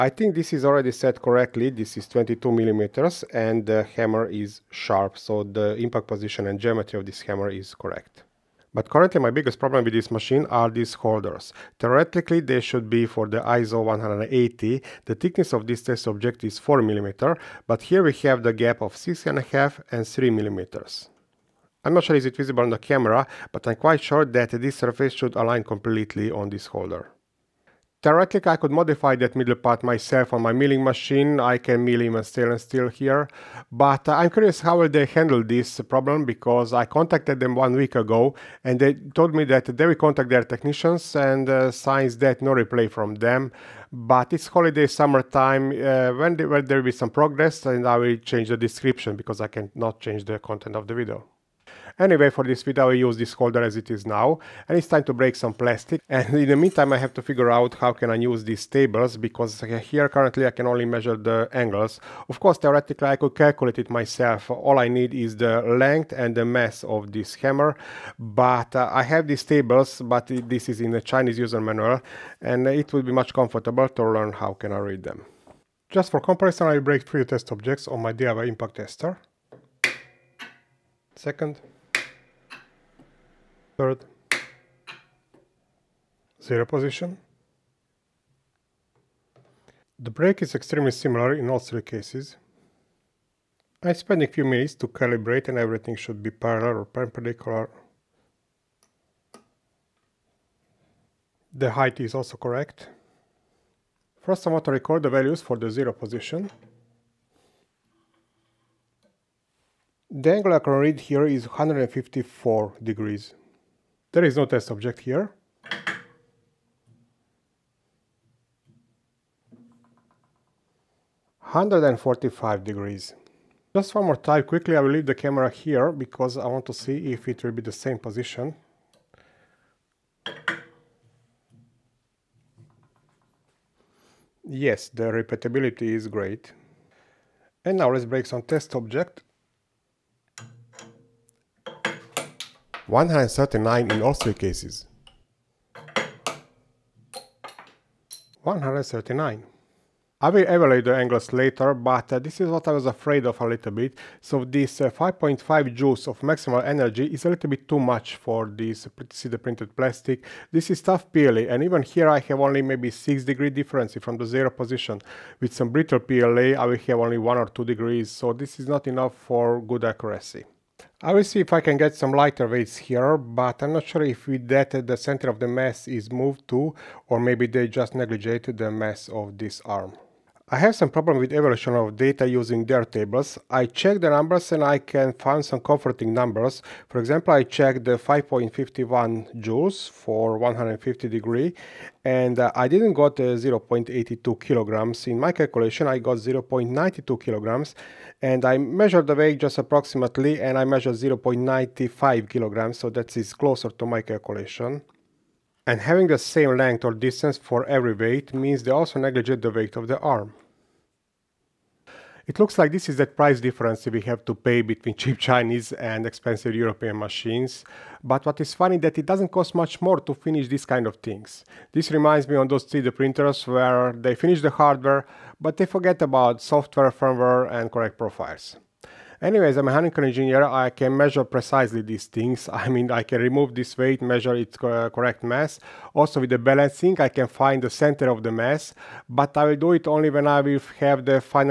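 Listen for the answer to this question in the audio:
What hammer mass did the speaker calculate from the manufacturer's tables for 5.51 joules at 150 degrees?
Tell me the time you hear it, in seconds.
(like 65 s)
196 s.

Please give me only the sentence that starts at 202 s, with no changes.
So that is closer to my calculation.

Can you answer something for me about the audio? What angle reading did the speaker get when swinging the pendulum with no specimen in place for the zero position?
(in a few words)
154 degrees.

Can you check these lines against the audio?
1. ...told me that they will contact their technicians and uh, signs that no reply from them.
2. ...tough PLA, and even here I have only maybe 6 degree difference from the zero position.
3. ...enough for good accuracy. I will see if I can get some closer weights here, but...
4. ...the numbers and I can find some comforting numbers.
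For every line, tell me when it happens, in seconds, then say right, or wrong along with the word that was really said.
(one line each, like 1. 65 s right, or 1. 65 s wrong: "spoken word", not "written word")
1. 38 s right
2. 160 s right
3. 168 s wrong: "lighter", not "closer"
4. 184 s right.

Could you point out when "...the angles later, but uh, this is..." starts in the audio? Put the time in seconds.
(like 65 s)
150 s.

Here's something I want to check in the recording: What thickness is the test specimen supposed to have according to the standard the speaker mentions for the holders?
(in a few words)
4 millimeters.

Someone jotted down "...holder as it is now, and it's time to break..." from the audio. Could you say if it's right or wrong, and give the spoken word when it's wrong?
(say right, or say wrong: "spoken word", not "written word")
right.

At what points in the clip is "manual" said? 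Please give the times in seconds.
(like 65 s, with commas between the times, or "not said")
71 s.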